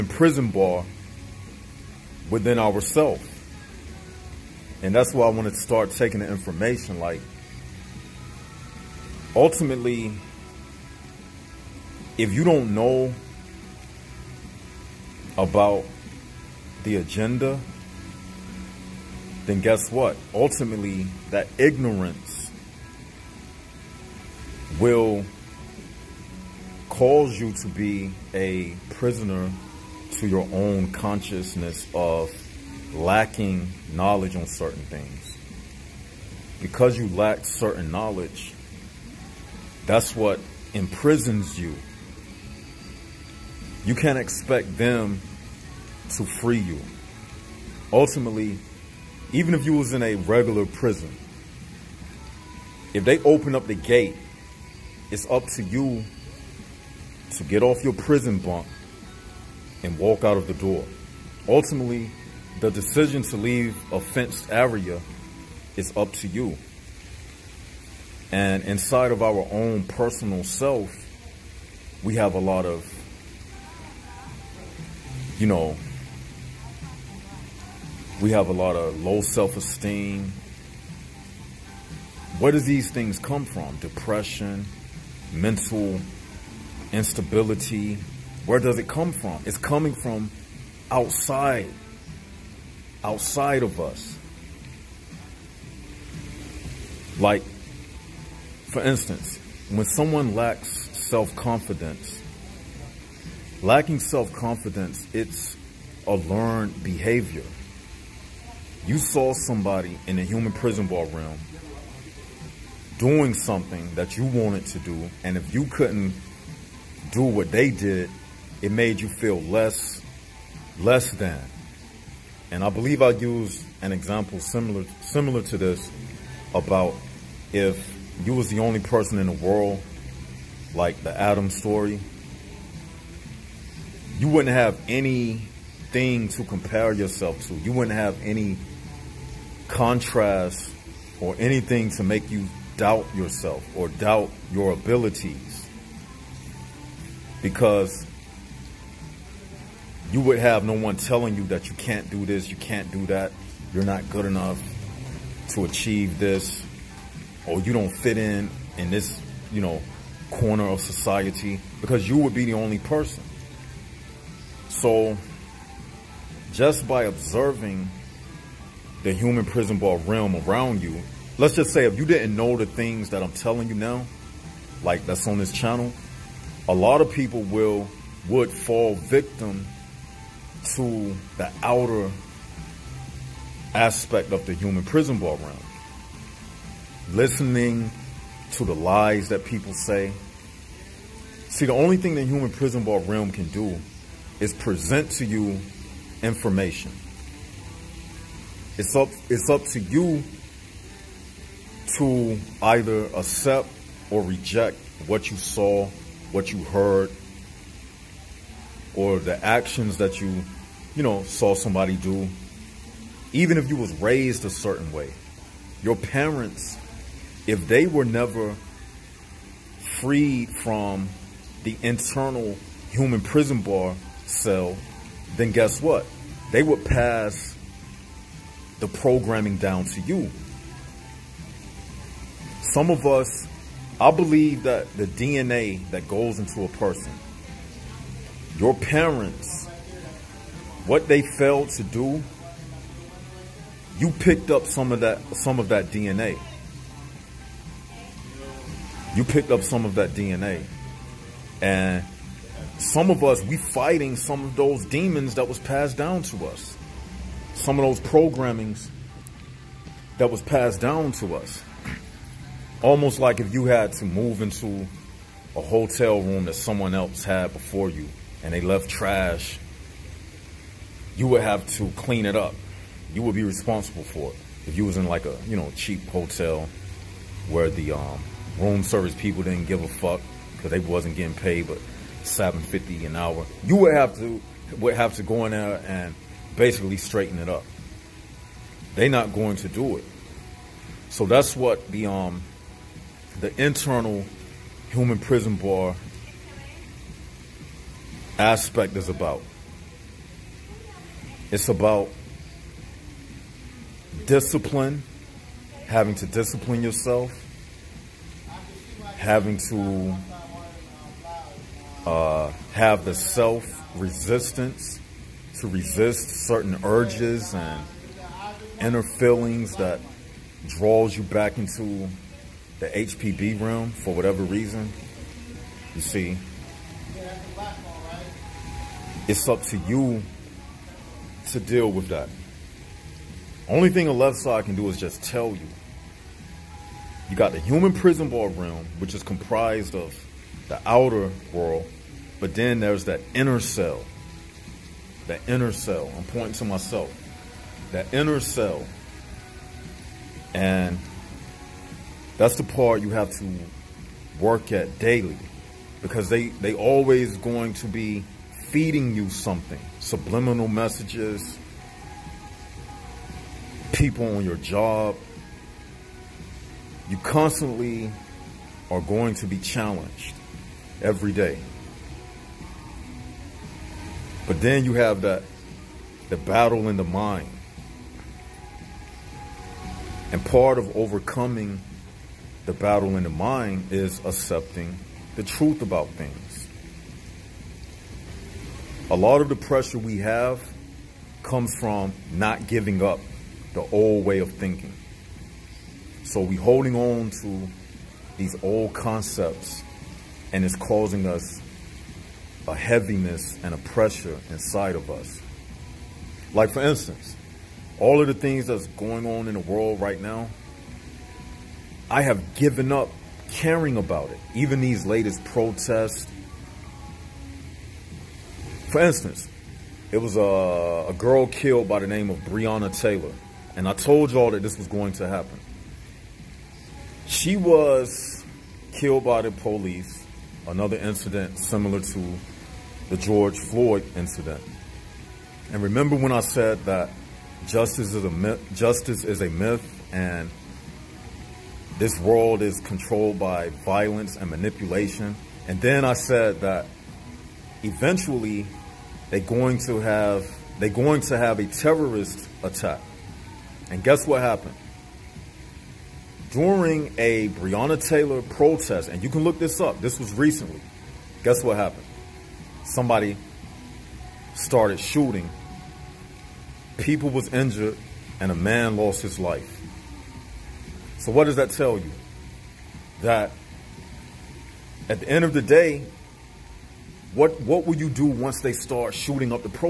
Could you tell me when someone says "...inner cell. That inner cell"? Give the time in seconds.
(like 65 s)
343 s.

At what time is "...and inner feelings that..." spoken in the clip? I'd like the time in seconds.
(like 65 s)
317 s.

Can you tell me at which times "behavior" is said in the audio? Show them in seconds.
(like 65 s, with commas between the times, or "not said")
106 s.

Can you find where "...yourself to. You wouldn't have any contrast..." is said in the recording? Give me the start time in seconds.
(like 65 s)
136 s.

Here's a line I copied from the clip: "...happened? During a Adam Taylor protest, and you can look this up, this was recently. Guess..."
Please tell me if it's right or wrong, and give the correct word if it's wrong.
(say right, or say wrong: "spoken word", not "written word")
wrong: "Breonna", not "Adam".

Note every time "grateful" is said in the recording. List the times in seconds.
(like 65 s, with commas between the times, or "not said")
not said.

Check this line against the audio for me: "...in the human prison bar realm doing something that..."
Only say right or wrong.
right.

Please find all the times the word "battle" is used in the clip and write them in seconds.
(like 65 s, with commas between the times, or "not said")
376 s, 382 s.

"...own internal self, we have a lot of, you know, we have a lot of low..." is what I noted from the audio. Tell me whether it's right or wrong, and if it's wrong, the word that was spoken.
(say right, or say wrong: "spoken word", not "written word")
wrong: "personal", not "internal".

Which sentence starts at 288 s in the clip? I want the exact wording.
They're not going to do it.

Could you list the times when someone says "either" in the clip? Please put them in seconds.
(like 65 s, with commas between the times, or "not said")
202 s.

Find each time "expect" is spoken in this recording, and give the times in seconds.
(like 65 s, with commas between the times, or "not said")
44 s.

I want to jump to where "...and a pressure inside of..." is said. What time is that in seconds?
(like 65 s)
403 s.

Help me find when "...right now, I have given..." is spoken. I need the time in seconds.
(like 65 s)
410 s.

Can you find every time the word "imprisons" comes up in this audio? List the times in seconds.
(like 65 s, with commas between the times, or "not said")
40 s.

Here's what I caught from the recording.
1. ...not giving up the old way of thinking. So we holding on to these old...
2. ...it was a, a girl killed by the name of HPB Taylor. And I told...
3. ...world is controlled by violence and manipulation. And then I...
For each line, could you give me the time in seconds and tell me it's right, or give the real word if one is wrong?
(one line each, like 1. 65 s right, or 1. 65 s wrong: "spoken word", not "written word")
1. 392 s right
2. 420 s wrong: "Breonna", not "HPB"
3. 442 s right.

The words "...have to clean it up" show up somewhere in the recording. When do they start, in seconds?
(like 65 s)
271 s.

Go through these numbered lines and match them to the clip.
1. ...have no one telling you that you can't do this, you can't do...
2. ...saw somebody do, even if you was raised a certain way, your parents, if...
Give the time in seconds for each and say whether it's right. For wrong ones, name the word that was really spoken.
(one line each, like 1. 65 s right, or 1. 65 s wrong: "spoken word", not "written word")
1. 150 s right
2. 211 s right.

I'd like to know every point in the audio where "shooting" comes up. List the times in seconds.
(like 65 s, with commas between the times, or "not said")
465 s, 479 s.